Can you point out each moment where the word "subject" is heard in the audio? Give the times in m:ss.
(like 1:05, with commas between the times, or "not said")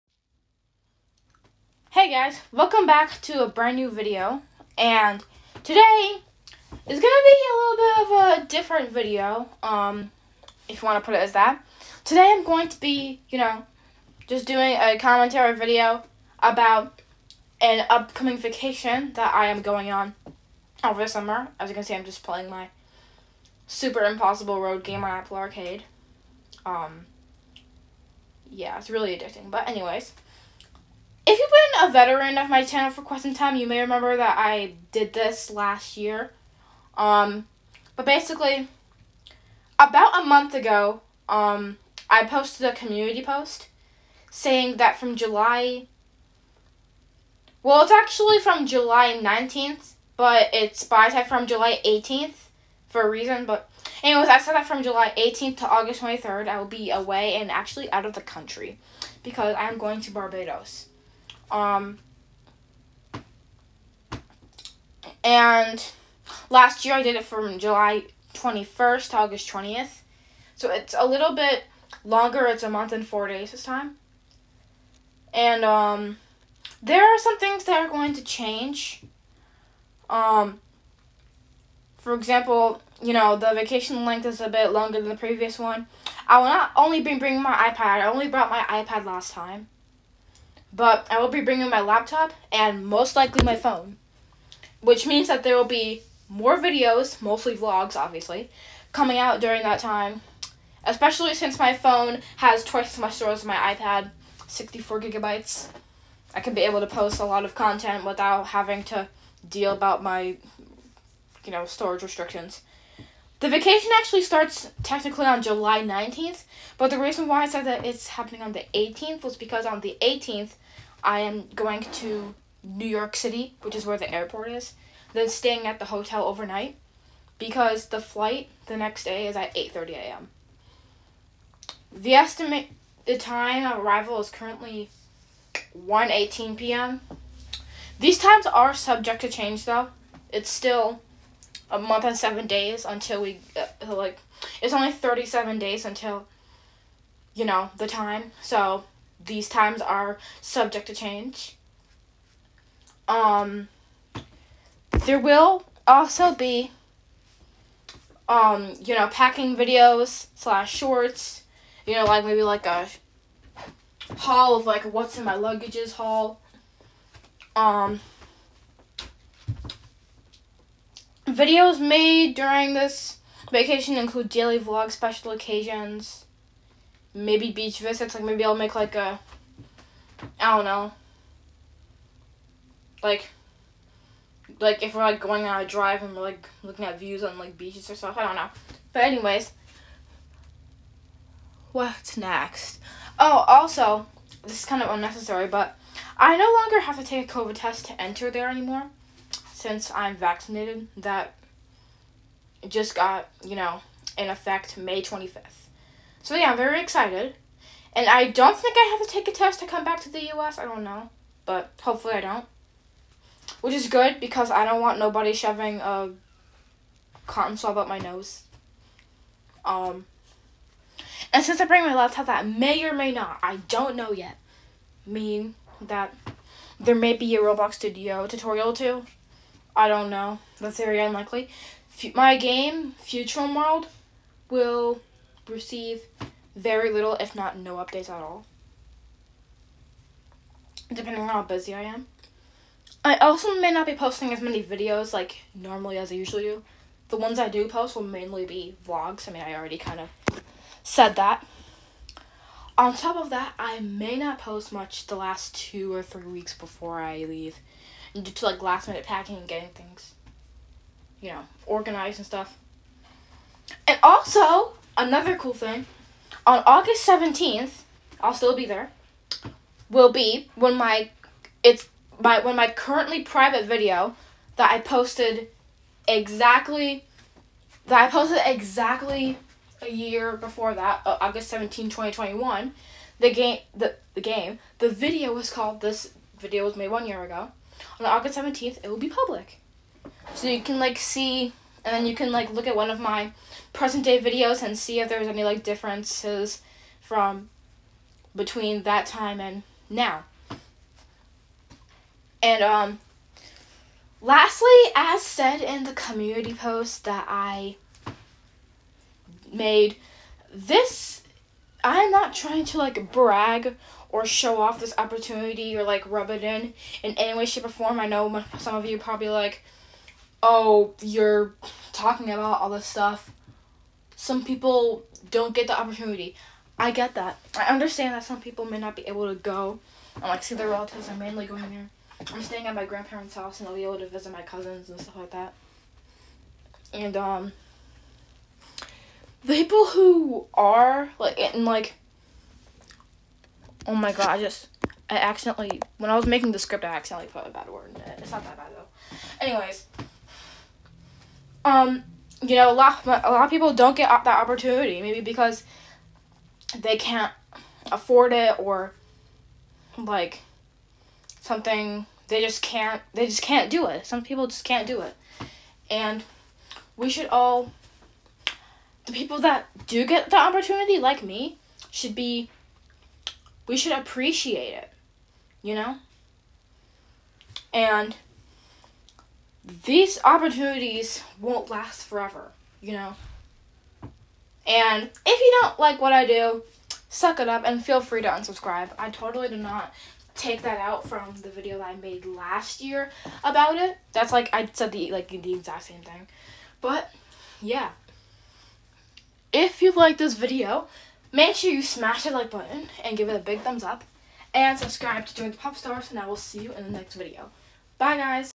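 2:18, 2:30.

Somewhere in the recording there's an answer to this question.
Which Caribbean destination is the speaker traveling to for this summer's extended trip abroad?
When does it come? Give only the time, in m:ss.
1:00.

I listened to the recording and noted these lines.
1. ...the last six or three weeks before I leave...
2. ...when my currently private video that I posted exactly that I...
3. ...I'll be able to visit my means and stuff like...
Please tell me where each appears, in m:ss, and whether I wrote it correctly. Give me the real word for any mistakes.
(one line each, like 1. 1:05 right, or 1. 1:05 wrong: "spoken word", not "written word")
1. 4:15 wrong: "two", not "six"
2. 4:32 right
3. 5:33 wrong: "cousins", not "means".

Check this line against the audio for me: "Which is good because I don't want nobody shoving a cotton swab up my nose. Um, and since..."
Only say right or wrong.
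right.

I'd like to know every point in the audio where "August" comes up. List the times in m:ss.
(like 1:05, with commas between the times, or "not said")
0:55, 1:09, 4:26, 4:41, 4:48.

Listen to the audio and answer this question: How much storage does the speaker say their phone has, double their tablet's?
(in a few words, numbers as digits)
64 gigabytes.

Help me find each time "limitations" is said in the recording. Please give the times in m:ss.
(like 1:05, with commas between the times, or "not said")
not said.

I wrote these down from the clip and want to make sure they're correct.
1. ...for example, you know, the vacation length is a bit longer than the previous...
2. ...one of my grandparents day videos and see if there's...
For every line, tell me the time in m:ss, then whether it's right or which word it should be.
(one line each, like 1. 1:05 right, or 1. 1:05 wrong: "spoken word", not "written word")
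1. 1:21 right
2. 4:52 wrong: "present", not "grandparents".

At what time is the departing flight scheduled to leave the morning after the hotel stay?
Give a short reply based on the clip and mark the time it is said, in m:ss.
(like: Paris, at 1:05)
8:30 a.m., at 2:09.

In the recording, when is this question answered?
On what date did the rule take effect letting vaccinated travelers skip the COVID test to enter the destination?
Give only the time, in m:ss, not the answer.
3:24.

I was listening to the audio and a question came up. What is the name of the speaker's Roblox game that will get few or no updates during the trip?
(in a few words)
Futurum World.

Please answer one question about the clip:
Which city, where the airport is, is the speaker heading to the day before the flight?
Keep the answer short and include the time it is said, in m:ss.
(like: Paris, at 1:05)
New York City, at 2:02.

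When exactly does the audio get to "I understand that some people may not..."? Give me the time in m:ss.
5:27.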